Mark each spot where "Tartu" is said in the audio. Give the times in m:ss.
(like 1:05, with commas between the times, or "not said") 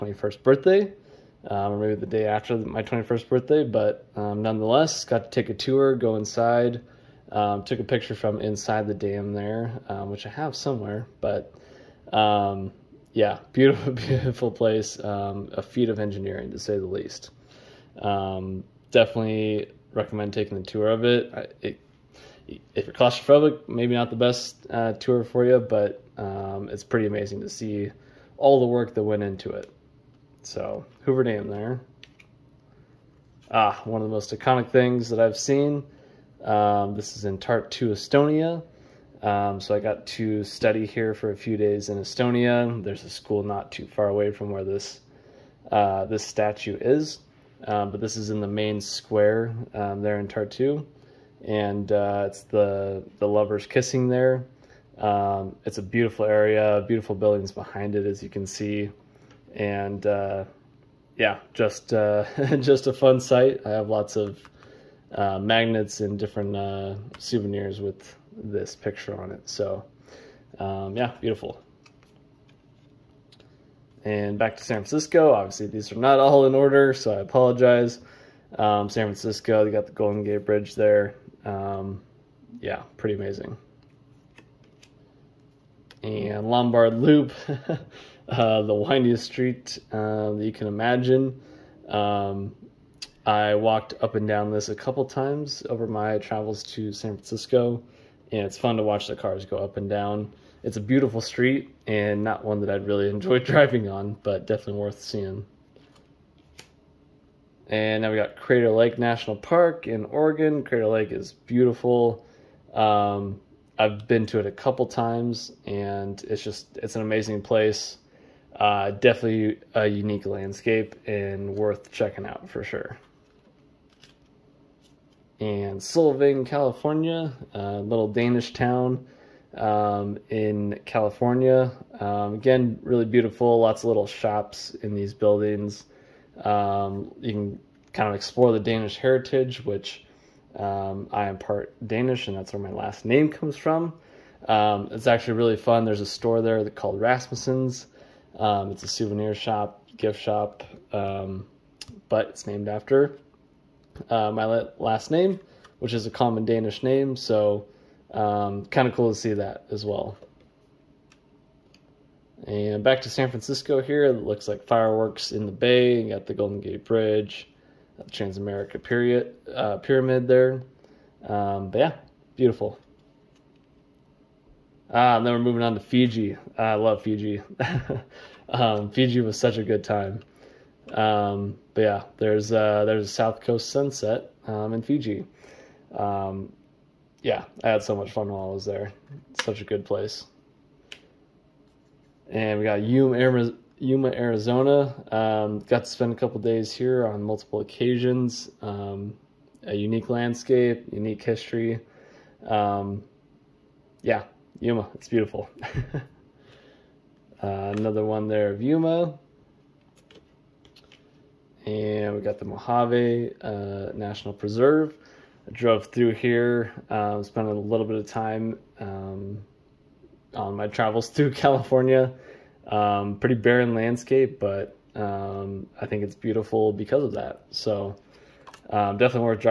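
0:37, 0:50.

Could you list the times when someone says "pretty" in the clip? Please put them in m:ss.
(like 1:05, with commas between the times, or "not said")
0:26, 1:22, 3:43.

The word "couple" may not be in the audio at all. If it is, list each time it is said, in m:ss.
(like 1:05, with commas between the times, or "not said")
1:34, 1:54, 3:16.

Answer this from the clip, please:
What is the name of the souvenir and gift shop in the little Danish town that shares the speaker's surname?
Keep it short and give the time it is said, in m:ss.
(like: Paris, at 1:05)
Rasmussen's, at 2:26.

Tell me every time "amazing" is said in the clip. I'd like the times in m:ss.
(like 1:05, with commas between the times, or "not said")
0:27, 1:23, 1:57.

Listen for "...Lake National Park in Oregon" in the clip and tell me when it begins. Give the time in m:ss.
1:48.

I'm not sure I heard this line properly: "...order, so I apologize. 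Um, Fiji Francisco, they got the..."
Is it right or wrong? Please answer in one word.
wrong.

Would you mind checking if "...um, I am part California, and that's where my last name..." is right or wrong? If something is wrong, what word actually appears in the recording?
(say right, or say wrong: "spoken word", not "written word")
wrong: "Danish", not "California".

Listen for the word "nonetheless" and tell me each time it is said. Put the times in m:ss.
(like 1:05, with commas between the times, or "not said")
0:04.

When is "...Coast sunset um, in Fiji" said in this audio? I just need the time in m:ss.
3:03.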